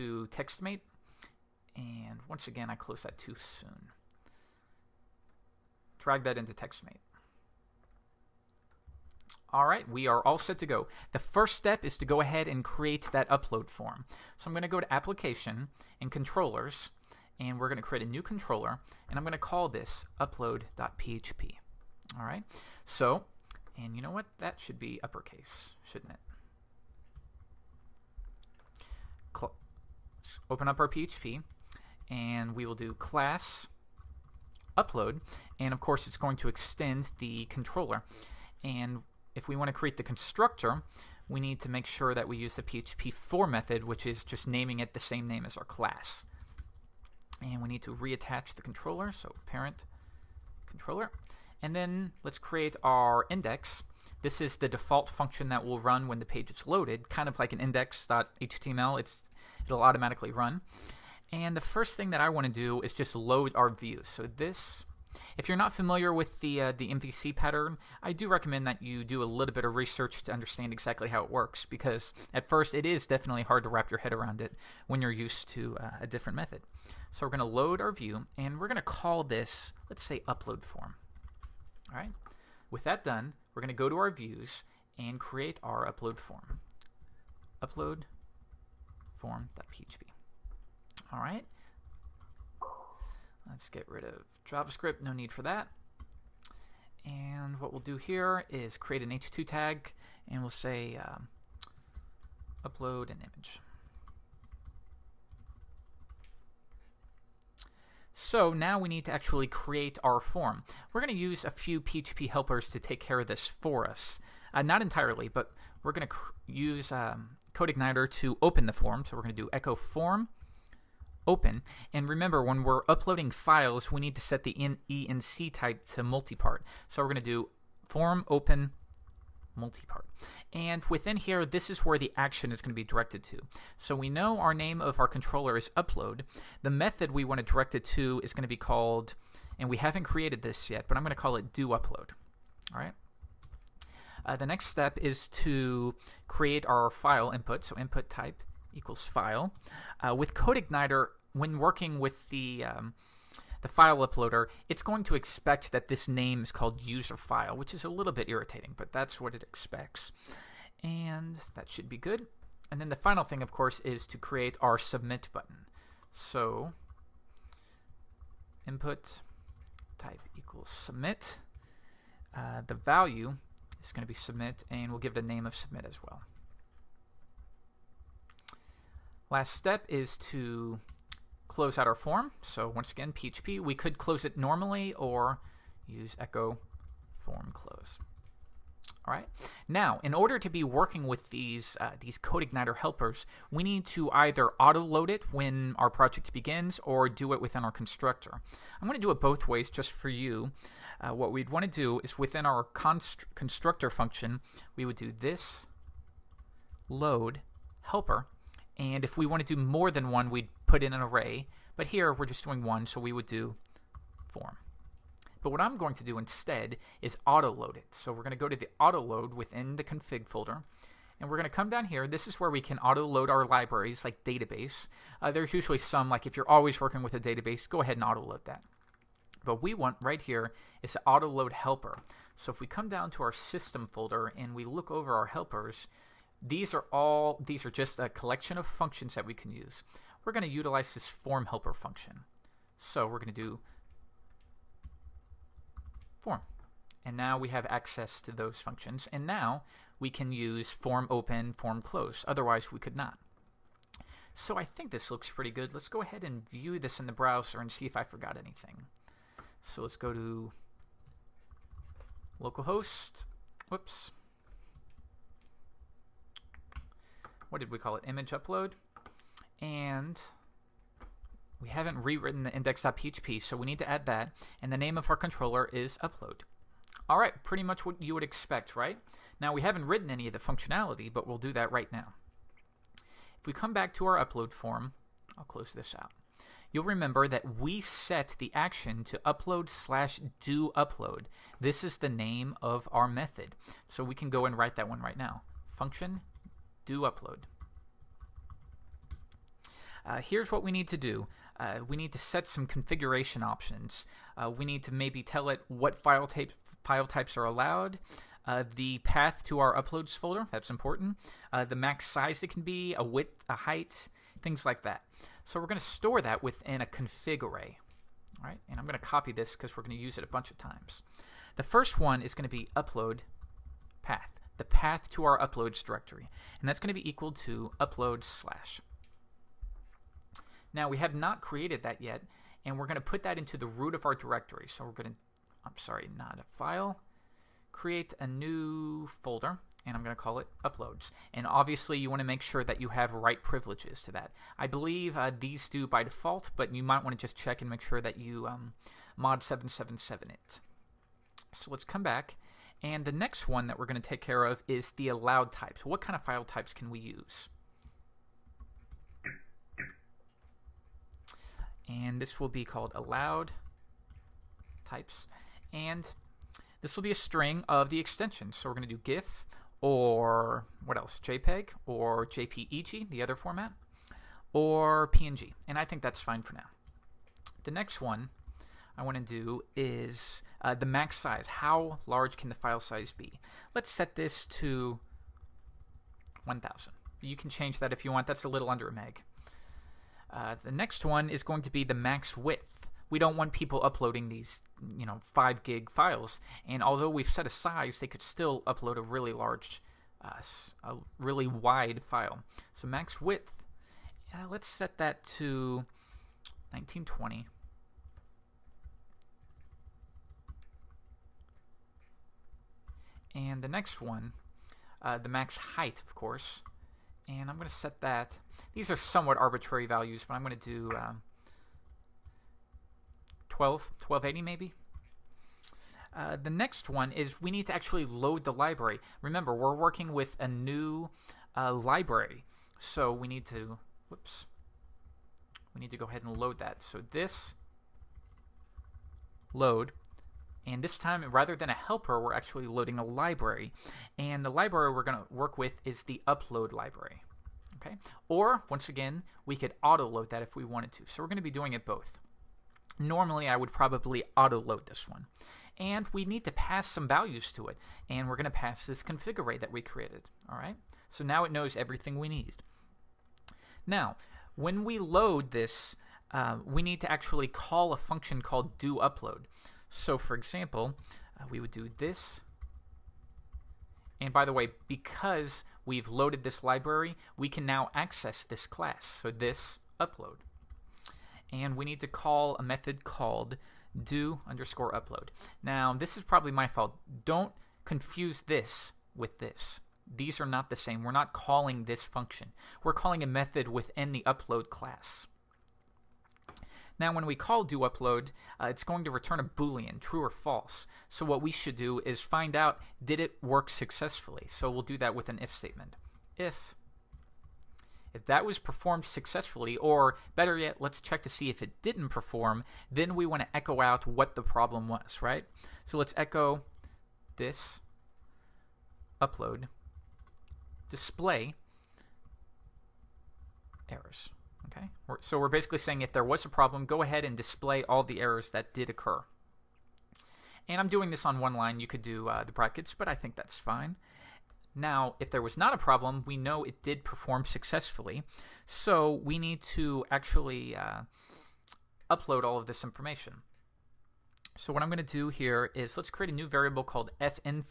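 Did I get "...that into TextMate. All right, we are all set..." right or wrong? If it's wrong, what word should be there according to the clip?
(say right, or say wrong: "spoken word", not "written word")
right.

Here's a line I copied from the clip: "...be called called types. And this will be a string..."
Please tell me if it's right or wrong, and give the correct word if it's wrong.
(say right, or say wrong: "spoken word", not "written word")
wrong: "allowed", not "called".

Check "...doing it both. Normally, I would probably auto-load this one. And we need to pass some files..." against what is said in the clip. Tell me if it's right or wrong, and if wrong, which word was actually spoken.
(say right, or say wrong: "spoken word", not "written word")
wrong: "values", not "files".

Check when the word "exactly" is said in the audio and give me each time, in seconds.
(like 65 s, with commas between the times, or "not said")
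70 s.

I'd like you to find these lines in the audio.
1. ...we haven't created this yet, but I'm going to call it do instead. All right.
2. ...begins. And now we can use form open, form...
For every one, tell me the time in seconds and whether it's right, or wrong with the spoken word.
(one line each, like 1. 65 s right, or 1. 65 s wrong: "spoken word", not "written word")
1. 139 s wrong: "upload", not "instead"
2. 248 s wrong: "functions", not "begins".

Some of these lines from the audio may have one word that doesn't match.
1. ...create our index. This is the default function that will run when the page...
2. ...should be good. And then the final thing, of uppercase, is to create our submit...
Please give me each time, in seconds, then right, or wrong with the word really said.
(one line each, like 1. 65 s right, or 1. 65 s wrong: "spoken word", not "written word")
1. 52 s right
2. 161 s wrong: "course", not "uppercase".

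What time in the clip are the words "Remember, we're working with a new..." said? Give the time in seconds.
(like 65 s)
429 s.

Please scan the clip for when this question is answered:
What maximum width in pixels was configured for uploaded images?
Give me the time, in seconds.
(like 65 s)
406 s.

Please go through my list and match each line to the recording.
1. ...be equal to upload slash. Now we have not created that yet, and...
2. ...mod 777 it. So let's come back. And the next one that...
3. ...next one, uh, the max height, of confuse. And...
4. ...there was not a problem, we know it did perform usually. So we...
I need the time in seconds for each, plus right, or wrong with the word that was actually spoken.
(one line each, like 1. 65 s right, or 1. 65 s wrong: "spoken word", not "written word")
1. 326 s right
2. 349 s right
3. 413 s wrong: "course", not "confuse"
4. 535 s wrong: "successfully", not "usually".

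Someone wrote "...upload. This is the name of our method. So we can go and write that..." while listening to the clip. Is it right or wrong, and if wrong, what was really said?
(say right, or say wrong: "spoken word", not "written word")
right.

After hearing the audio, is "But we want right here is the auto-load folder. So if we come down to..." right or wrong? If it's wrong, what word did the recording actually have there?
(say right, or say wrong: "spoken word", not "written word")
wrong: "helper", not "folder".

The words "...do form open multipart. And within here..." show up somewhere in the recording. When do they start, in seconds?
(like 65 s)
127 s.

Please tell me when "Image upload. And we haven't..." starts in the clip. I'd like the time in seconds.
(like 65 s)
268 s.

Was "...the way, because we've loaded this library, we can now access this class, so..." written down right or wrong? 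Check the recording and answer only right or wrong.
right.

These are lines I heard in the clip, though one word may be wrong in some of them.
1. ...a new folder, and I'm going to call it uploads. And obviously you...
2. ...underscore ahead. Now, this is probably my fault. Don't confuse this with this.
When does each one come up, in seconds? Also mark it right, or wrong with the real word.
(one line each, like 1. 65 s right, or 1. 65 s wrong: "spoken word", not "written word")
1. 338 s right
2. 484 s wrong: "upload", not "ahead".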